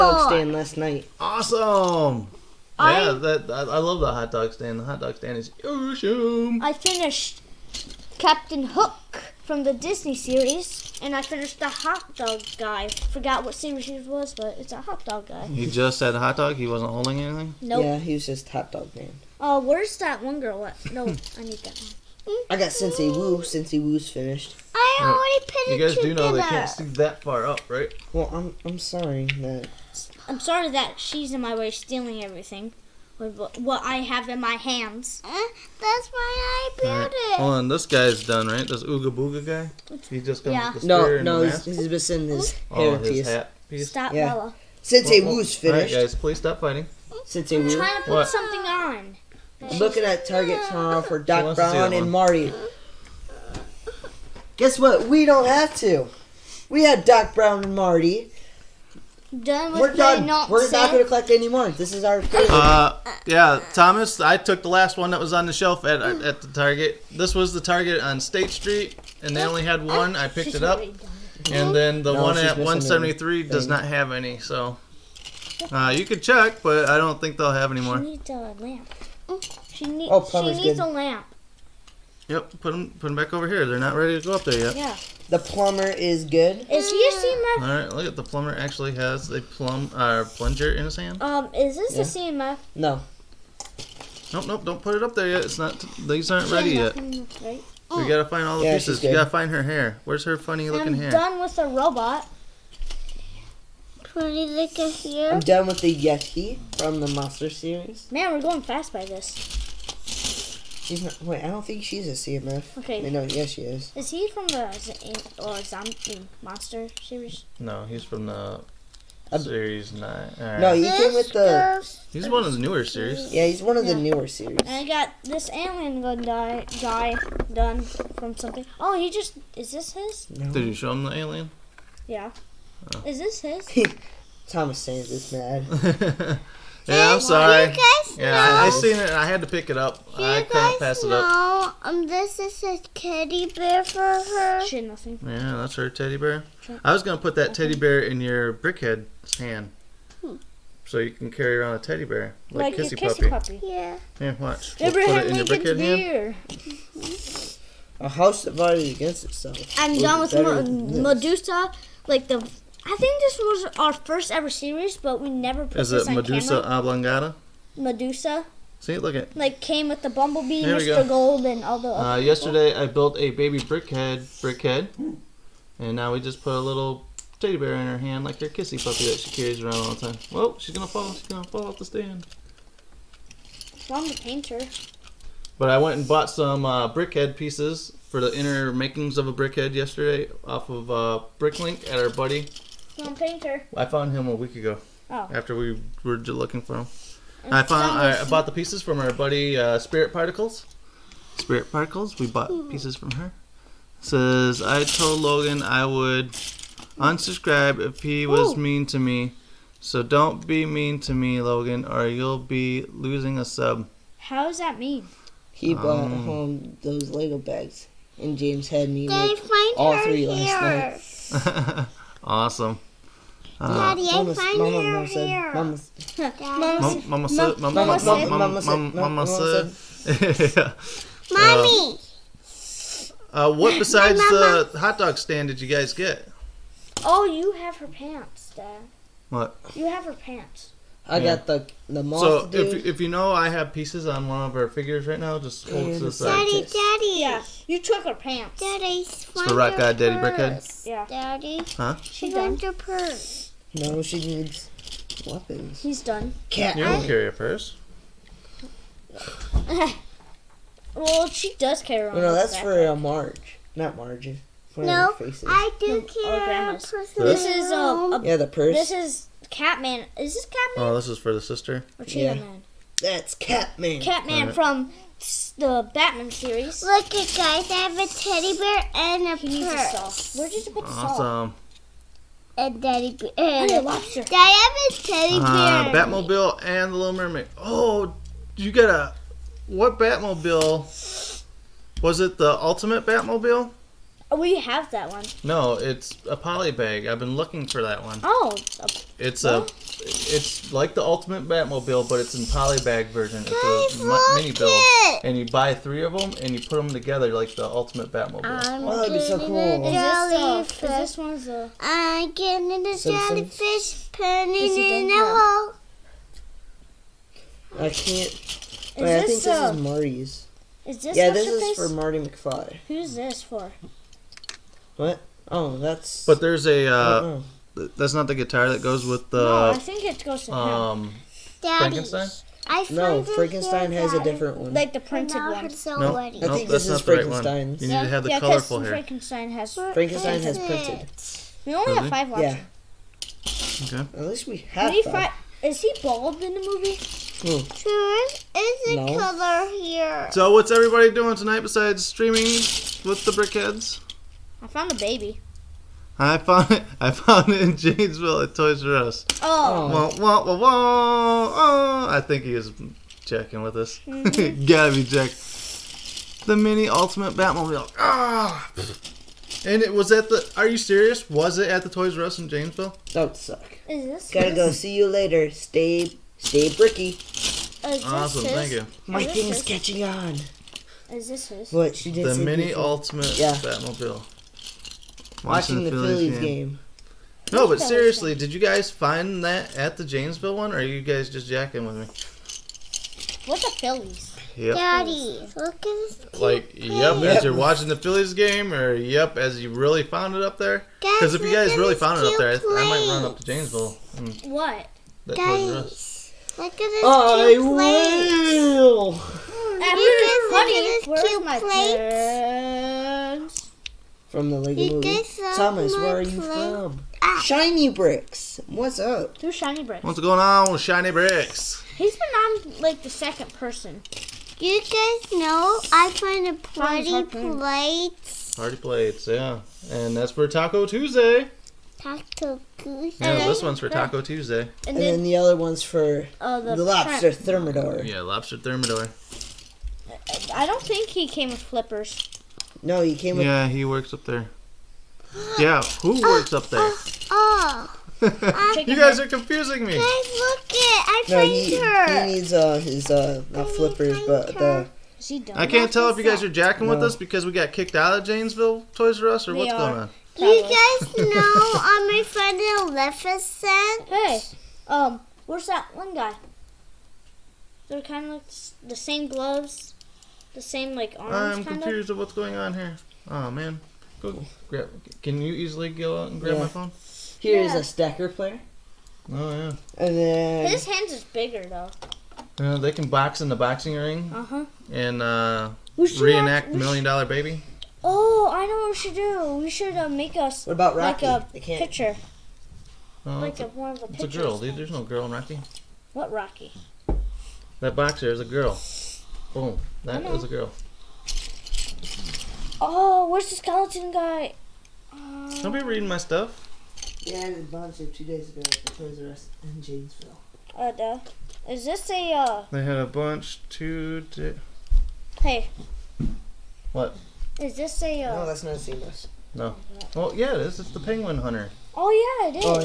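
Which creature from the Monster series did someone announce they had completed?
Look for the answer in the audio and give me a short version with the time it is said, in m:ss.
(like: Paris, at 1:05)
Yeti, at 1:45.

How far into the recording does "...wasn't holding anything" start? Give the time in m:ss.
0:16.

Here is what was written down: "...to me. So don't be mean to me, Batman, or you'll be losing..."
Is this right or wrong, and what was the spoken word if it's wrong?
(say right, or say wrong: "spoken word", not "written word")
wrong: "Logan", not "Batman".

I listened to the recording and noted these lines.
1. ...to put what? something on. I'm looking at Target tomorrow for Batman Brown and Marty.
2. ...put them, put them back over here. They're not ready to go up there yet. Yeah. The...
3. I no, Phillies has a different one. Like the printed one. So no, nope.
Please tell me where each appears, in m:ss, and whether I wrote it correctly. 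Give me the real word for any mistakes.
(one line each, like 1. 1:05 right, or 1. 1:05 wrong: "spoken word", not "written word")
1. 0:47 wrong: "Doc", not "Batman"
2. 1:22 right
3. 5:32 wrong: "Frankenstein", not "Phillies".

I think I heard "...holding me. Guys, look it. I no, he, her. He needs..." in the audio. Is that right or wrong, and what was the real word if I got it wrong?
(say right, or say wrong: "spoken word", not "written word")
wrong: "confusing", not "holding".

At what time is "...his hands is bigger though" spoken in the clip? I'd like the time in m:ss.
8:00.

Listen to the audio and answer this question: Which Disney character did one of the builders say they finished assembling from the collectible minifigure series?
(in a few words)
Captain Hook.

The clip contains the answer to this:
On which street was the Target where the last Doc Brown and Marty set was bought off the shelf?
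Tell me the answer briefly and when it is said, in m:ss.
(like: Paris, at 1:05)
State Street, at 1:08.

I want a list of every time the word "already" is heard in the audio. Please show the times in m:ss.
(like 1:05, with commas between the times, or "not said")
0:25.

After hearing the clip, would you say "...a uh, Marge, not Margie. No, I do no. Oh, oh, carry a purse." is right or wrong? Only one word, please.
right.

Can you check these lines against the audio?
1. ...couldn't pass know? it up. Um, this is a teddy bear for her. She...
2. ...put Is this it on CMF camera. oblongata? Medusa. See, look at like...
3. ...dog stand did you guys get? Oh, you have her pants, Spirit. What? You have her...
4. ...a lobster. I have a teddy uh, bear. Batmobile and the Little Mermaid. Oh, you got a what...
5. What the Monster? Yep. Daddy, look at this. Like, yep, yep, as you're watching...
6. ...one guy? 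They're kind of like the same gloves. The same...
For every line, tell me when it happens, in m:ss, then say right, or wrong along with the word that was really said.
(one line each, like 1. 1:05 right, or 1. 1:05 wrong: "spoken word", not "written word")
1. 2:20 right
2. 2:45 wrong: "Medusa", not "CMF"
3. 3:54 wrong: "Dad", not "Spirit"
4. 4:43 right
5. 6:33 wrong: "Phillies", not "Monster"
6. 7:45 right.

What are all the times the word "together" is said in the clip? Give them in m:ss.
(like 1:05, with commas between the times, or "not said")
0:25, 5:06.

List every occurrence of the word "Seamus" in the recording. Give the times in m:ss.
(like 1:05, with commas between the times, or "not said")
8:38.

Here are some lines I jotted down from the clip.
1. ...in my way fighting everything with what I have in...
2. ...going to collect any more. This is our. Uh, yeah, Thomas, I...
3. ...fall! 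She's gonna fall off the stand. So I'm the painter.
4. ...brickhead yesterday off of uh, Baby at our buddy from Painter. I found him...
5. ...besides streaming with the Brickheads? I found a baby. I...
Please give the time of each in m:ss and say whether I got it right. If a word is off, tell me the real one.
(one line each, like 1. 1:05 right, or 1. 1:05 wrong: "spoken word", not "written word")
1. 0:31 wrong: "stealing", not "fighting"
2. 1:00 right
3. 3:00 right
4. 3:09 wrong: "Bricklink", not "Baby"
5. 5:51 right.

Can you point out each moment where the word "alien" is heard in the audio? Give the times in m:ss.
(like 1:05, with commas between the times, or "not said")
2:05, 2:11.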